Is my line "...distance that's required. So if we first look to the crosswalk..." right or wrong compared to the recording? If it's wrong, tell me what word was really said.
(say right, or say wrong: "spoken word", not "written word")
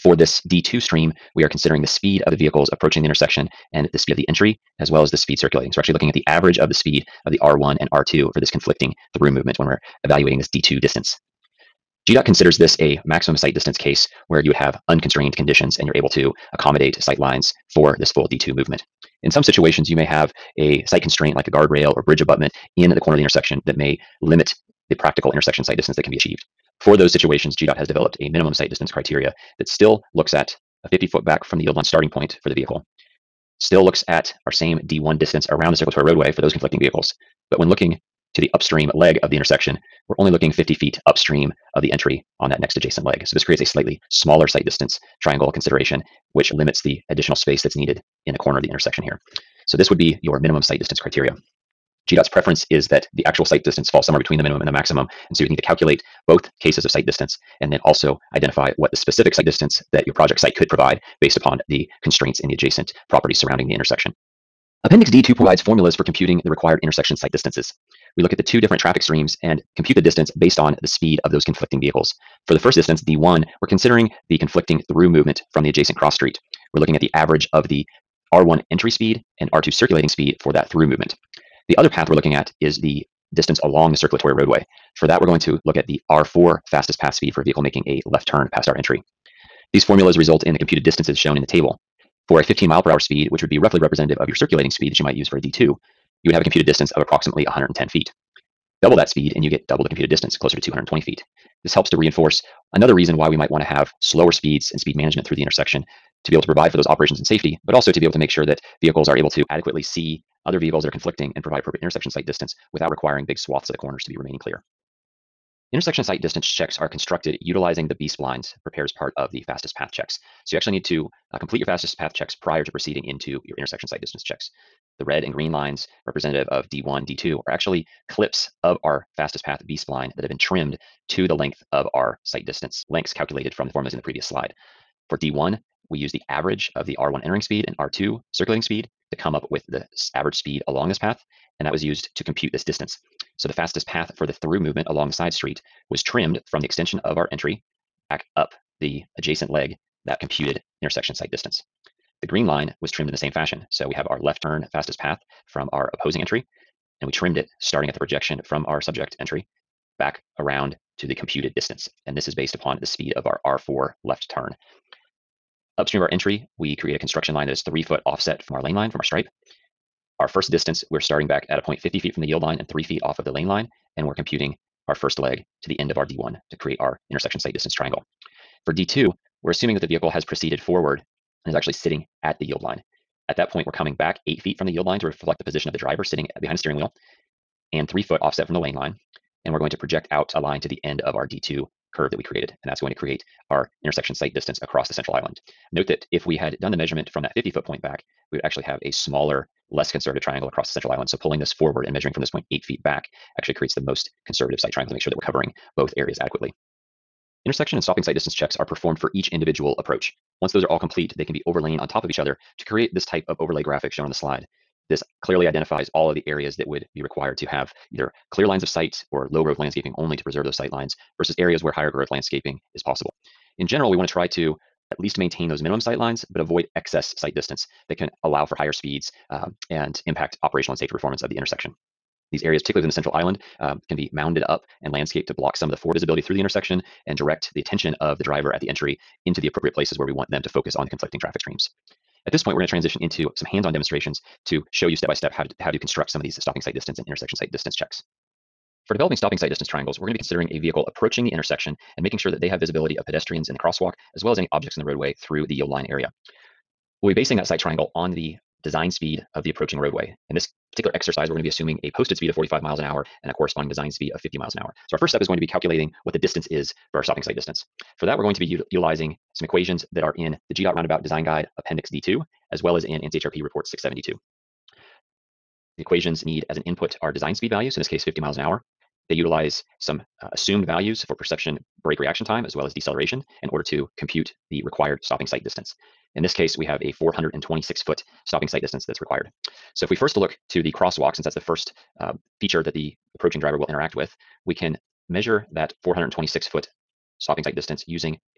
right.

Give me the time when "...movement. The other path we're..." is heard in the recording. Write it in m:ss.
1:20.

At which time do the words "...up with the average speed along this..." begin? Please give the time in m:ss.
2:19.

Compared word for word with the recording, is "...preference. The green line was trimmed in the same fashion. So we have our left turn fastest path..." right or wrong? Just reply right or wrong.
wrong.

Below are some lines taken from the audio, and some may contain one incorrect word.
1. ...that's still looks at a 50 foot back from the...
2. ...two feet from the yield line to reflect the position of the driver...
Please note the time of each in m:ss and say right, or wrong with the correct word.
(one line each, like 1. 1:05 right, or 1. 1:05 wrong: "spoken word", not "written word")
1. 0:29 right
2. 3:04 wrong: "eight", not "two".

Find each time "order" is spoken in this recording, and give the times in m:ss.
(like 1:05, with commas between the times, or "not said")
4:43.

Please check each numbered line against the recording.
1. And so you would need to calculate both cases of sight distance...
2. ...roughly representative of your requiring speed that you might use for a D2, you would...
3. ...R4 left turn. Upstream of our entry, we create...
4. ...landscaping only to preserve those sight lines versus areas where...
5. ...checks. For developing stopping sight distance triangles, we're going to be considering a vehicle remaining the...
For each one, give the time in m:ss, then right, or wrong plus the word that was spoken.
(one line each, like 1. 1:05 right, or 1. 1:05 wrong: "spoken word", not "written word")
1. 0:55 right
2. 1:33 wrong: "circulating", not "requiring"
3. 2:43 right
4. 3:39 right
5. 4:07 wrong: "approaching", not "remaining".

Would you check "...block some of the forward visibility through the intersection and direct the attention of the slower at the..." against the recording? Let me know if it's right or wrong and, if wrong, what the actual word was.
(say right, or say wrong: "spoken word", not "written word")
wrong: "driver", not "slower".